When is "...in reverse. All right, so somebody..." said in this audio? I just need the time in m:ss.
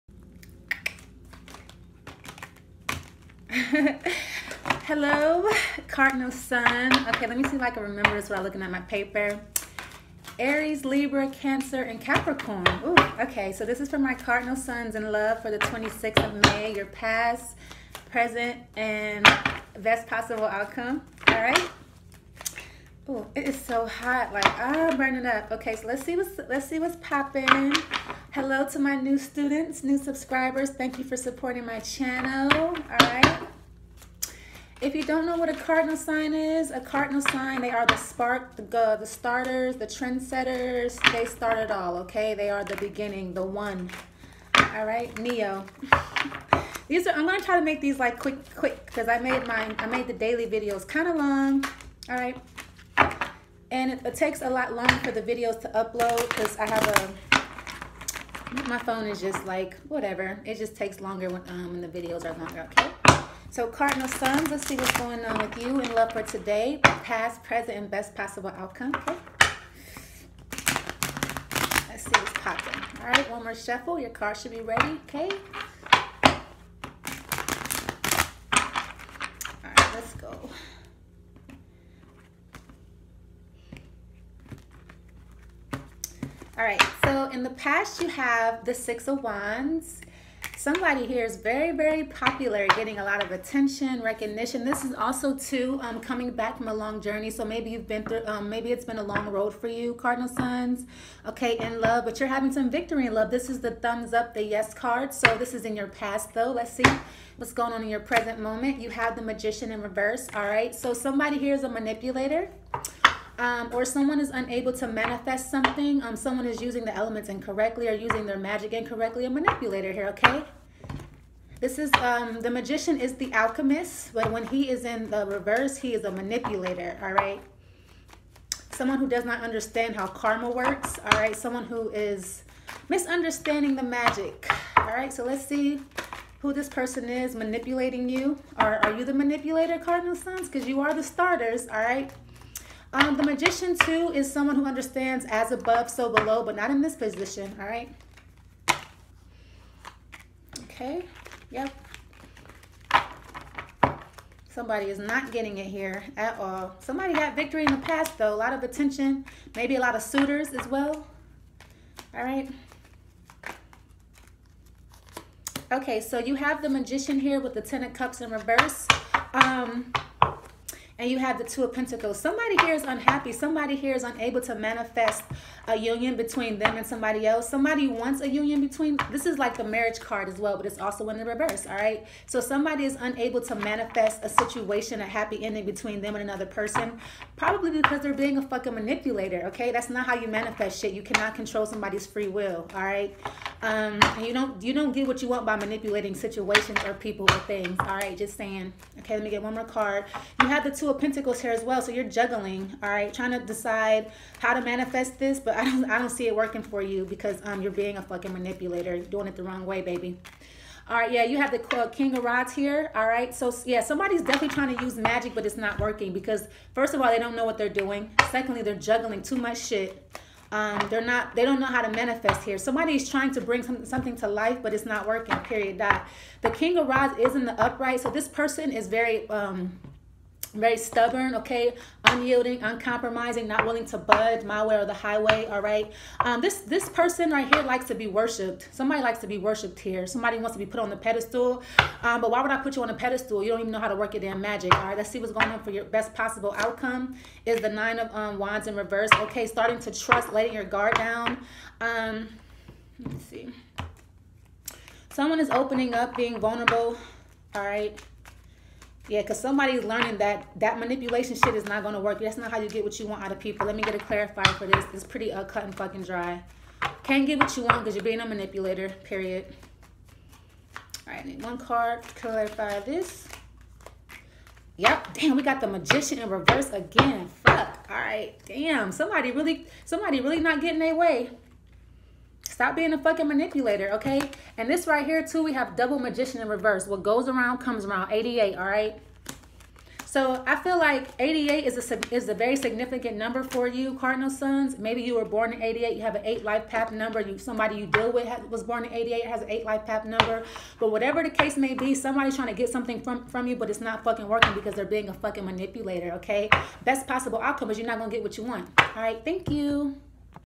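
1:49.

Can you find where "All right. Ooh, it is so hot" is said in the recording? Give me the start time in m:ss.
0:21.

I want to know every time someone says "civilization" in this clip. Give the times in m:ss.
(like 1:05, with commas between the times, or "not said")
not said.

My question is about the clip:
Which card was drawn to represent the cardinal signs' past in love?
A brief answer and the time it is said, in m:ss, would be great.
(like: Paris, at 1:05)
Six of Wands, at 1:28.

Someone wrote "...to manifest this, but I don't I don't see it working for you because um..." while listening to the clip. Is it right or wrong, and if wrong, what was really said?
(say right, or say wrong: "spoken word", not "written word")
right.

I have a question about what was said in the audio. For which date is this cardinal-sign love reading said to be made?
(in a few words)
May 26.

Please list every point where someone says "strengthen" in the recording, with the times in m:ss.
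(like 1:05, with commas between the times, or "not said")
not said.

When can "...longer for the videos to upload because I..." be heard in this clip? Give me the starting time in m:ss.
0:54.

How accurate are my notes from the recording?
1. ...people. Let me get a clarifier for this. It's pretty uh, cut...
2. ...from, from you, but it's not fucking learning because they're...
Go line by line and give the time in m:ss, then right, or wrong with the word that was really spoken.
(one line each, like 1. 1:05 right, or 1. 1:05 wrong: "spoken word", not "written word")
1. 4:23 right
2. 5:03 wrong: "working", not "learning".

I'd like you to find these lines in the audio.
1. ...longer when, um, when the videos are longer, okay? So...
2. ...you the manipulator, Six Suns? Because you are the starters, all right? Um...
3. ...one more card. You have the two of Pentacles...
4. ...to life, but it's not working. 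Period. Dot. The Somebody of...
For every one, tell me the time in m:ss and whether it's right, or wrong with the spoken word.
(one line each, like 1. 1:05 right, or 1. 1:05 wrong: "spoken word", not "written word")
1. 1:00 right
2. 2:18 wrong: "Cardinal", not "Six"
3. 3:19 right
4. 3:44 wrong: "King", not "Somebody".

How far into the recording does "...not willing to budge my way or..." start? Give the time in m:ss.
3:53.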